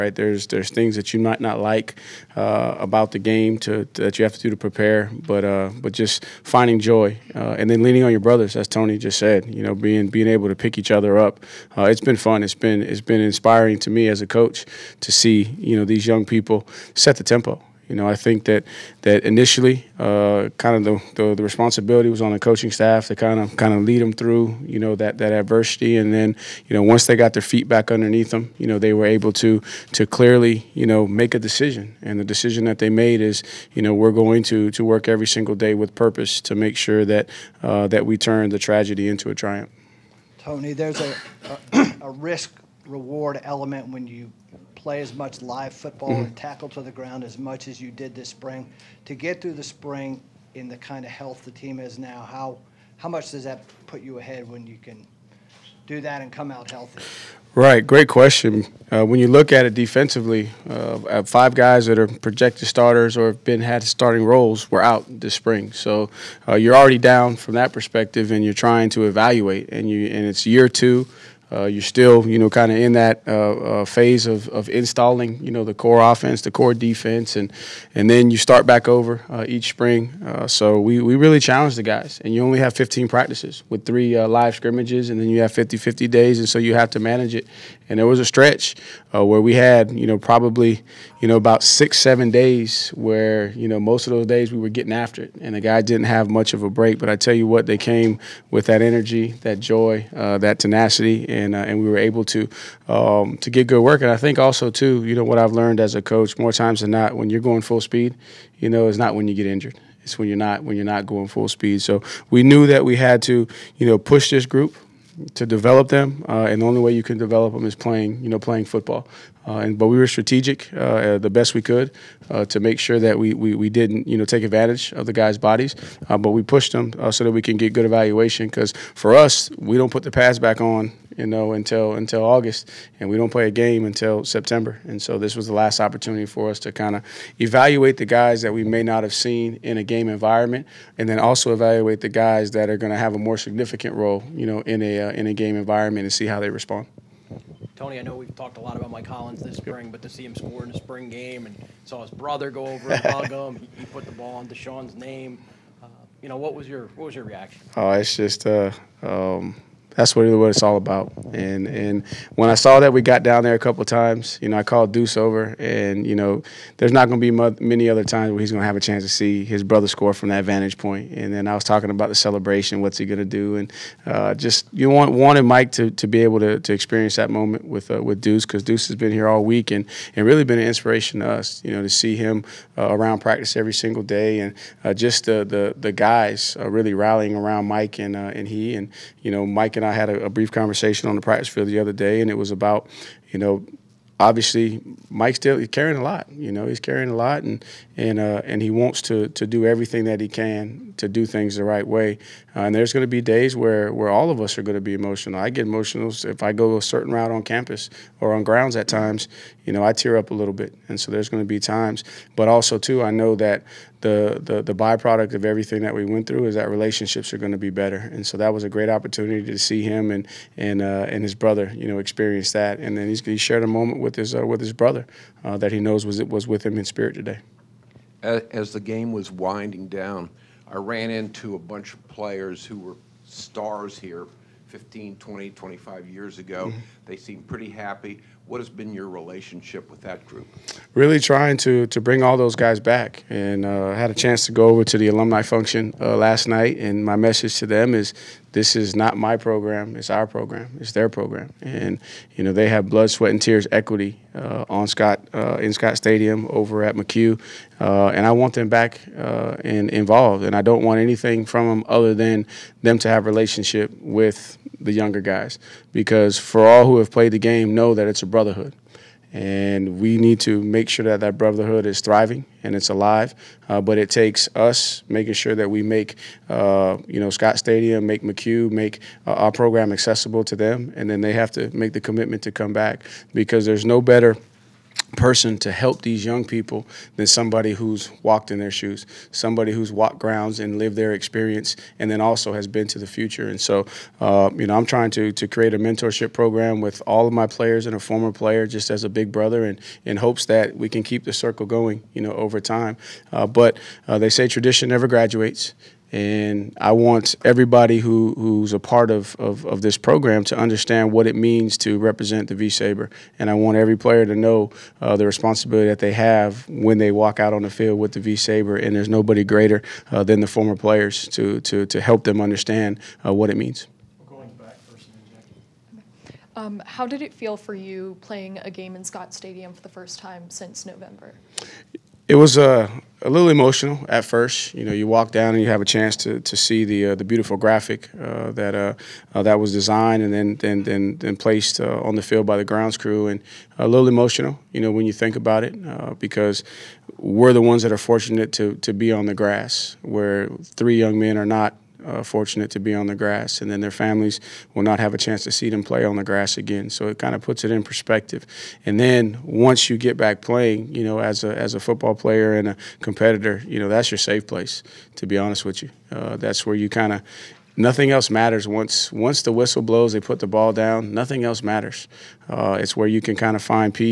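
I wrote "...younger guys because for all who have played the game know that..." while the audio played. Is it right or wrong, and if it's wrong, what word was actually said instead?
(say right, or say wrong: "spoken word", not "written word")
right.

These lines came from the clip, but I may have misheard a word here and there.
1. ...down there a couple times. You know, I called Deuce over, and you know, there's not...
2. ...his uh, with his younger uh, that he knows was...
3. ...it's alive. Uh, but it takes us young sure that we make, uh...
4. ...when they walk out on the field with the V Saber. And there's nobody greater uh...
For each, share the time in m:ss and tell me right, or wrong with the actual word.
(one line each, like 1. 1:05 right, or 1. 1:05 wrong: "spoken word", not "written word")
1. 2:43 right
2. 3:44 wrong: "brother", not "younger"
3. 4:32 wrong: "making", not "young"
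4. 5:16 right.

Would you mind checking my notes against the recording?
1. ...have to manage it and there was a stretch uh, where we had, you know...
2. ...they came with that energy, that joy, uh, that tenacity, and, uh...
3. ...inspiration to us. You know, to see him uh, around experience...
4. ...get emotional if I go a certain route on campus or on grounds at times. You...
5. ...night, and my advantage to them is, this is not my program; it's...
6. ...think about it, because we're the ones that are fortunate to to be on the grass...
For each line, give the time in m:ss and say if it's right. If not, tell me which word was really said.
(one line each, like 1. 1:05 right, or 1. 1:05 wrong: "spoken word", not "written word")
1. 1:26 right
2. 1:37 right
3. 3:00 wrong: "practice", not "experience"
4. 3:25 right
5. 4:06 wrong: "message", not "advantage"
6. 5:45 right.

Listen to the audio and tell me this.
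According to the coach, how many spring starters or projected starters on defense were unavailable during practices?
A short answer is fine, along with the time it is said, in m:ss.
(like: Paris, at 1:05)
5, at 1:01.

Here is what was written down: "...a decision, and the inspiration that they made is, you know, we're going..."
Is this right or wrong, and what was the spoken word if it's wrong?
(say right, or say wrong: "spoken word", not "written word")
wrong: "decision", not "inspiration".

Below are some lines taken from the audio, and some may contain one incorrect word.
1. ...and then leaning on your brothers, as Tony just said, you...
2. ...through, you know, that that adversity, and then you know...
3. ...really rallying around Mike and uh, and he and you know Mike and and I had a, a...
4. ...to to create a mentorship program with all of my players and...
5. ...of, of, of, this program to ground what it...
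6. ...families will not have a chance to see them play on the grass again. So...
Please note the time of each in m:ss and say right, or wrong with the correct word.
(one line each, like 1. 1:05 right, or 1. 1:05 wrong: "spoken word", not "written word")
1. 0:07 right
2. 0:24 right
3. 3:06 right
4. 4:55 right
5. 5:09 wrong: "understand", not "ground"
6. 5:53 right.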